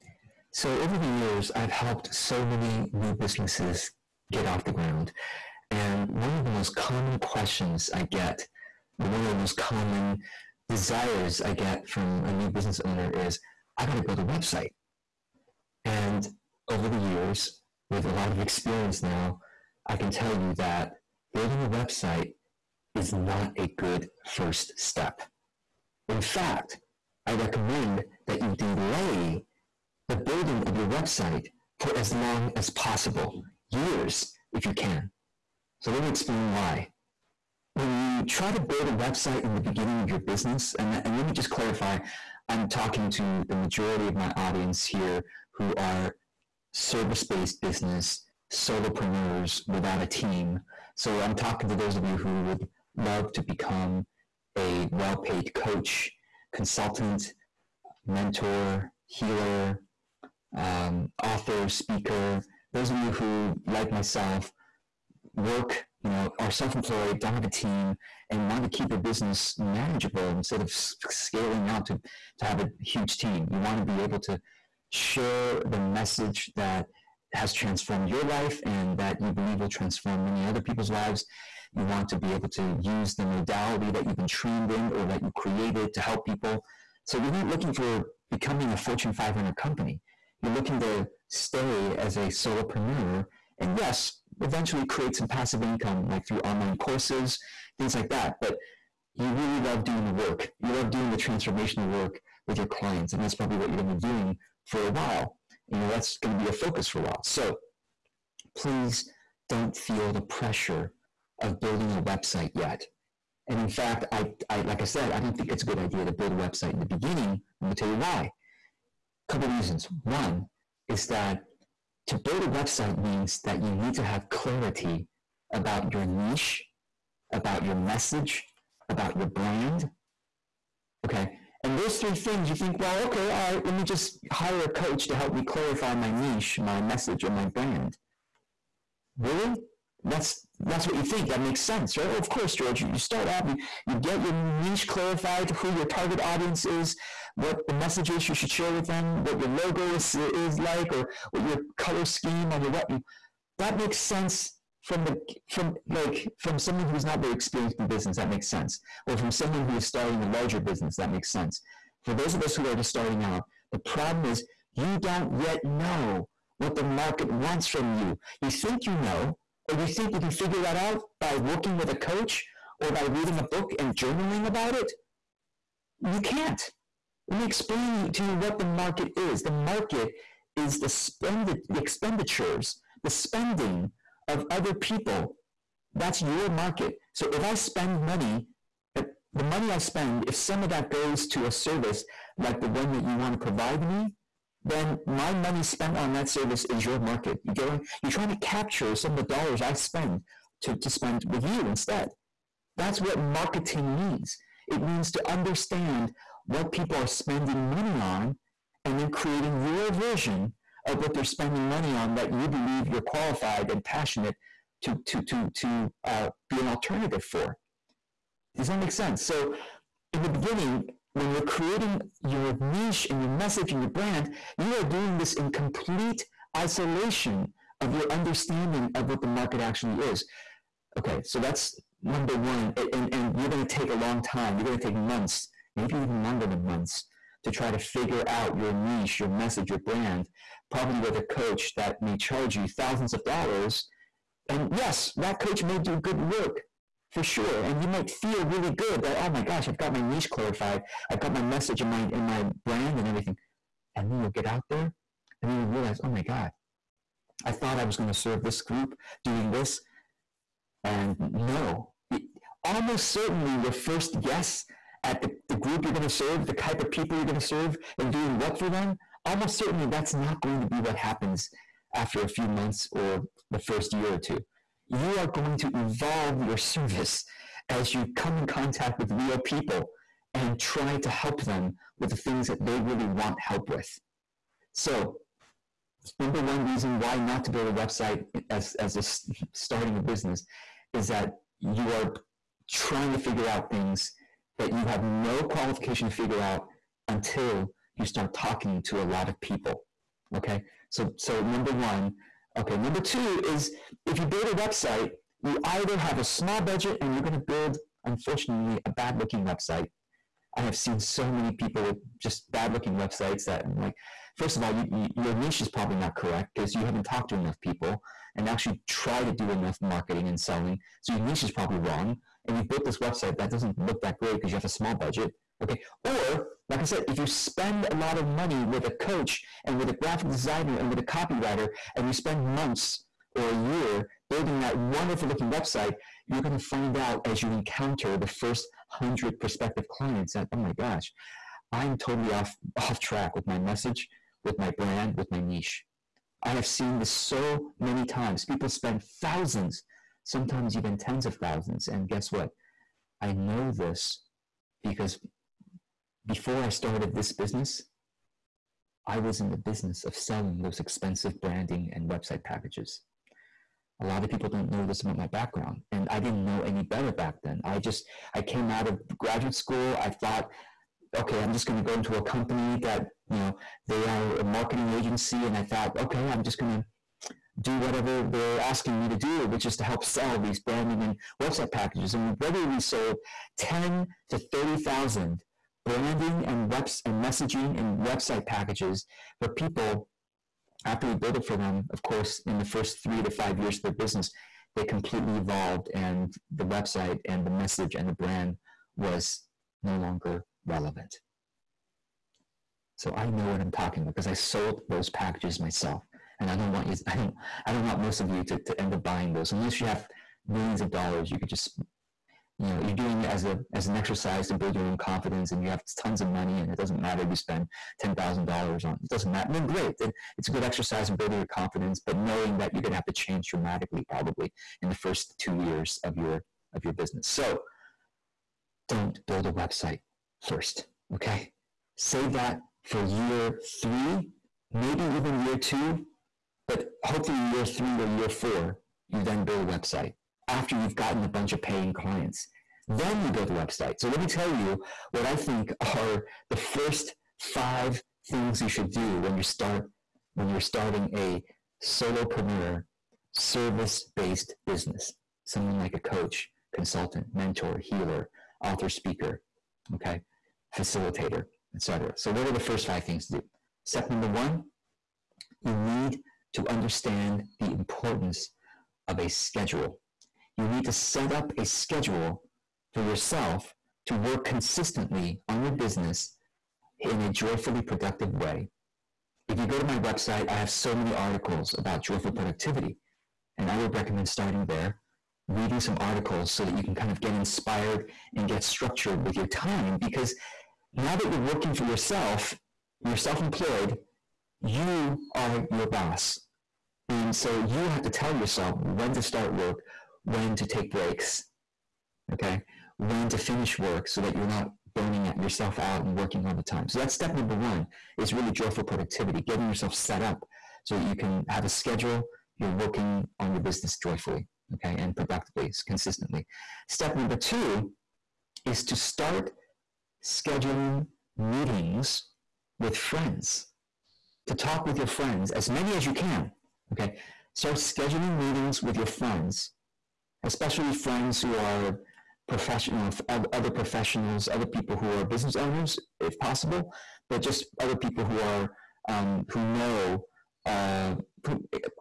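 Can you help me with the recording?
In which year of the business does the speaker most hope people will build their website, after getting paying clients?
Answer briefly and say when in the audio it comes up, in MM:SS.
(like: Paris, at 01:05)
year 3 or 4, at 07:17.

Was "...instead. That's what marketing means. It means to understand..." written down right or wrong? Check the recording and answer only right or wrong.
right.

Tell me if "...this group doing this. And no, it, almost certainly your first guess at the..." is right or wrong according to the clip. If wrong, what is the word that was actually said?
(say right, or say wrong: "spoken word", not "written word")
right.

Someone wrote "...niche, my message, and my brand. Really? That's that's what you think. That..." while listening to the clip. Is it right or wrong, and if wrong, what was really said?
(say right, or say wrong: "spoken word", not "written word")
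right.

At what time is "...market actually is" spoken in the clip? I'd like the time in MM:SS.
03:49.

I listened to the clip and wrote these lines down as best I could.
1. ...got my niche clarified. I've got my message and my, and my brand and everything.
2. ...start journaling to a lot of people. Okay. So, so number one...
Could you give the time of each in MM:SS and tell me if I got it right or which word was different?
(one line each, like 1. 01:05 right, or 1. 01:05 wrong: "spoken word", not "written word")
1. 04:09 right
2. 04:58 wrong: "talking", not "journaling".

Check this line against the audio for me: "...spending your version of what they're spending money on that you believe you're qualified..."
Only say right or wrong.
wrong.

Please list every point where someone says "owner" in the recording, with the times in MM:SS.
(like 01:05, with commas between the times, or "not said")
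00:12, 08:55.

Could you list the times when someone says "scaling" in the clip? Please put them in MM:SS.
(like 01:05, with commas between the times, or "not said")
01:10.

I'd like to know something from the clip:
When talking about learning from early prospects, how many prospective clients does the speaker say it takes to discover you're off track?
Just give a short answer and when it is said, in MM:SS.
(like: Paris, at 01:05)
100, at 05:38.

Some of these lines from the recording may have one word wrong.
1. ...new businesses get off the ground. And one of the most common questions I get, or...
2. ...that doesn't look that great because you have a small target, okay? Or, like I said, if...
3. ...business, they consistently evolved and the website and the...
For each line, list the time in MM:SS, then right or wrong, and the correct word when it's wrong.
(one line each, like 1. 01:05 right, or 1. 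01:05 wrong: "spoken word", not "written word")
1. 00:02 right
2. 05:23 wrong: "budget", not "target"
3. 06:33 wrong: "completely", not "consistently".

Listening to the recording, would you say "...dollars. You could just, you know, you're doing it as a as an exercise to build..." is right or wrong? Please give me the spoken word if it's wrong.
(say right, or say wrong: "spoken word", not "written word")
right.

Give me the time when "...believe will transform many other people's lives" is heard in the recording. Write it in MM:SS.
01:19.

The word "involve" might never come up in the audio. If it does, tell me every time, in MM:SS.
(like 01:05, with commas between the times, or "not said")
not said.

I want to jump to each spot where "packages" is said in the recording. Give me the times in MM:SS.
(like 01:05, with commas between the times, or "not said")
06:02, 06:21, 06:28, 06:45.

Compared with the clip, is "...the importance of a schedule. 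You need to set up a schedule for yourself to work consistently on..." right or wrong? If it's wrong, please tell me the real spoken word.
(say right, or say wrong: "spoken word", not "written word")
right.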